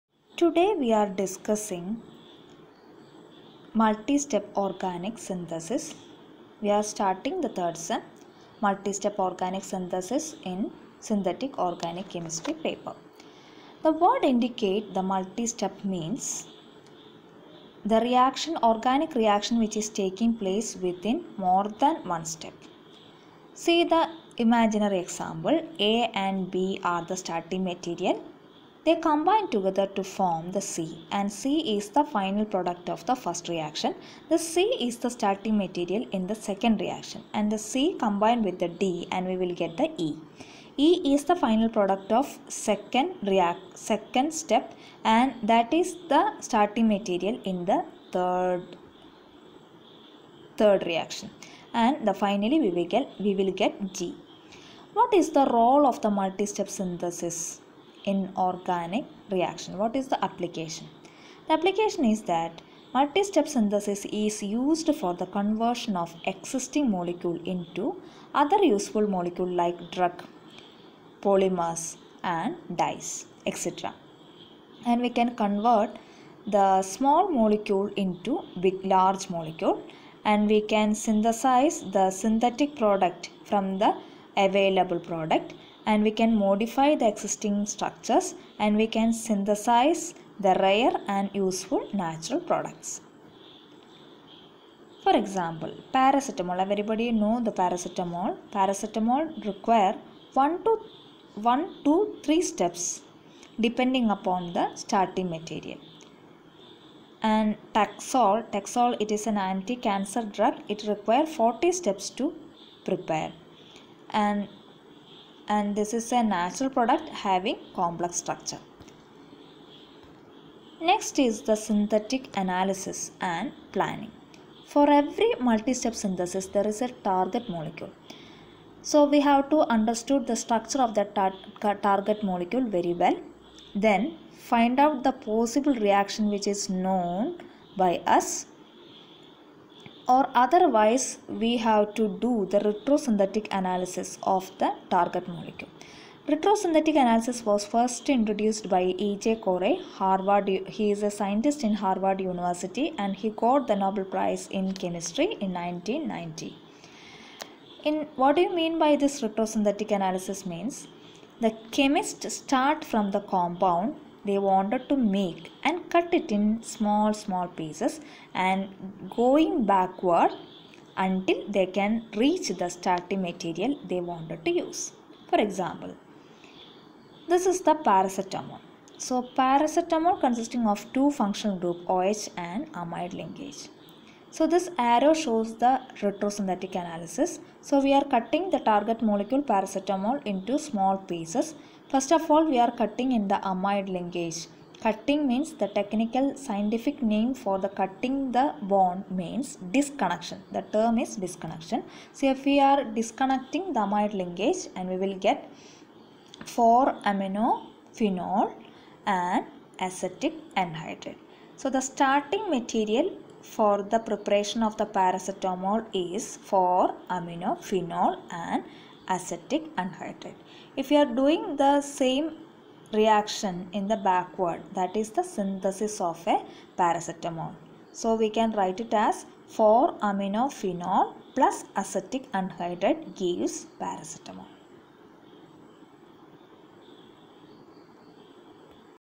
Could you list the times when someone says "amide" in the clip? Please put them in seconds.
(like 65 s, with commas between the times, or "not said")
182 s, 193 s, 203 s.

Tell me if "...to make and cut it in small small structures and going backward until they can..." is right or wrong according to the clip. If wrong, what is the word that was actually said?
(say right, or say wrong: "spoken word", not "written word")
wrong: "pieces", not "structures".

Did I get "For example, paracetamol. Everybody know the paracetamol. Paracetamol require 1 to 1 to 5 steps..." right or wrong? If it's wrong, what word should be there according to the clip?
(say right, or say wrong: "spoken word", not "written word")
wrong: "3", not "5".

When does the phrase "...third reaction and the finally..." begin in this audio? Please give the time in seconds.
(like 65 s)
50 s.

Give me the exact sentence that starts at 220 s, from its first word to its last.
If you are doing the same reaction in the backward that is the synthesis of a paracetamol.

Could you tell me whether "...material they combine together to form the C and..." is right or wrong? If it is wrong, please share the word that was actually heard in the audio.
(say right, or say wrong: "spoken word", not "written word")
right.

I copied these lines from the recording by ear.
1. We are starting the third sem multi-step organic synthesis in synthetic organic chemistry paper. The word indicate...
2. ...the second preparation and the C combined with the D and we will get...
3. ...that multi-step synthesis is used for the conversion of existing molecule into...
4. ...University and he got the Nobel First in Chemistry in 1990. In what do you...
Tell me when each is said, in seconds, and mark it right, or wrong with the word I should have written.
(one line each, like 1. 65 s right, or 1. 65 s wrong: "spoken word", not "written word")
1. 6 s right
2. 36 s wrong: "reaction", not "preparation"
3. 62 s right
4. 152 s wrong: "Prize", not "First".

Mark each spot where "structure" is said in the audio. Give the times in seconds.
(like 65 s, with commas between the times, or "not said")
87 s, 118 s, 130 s.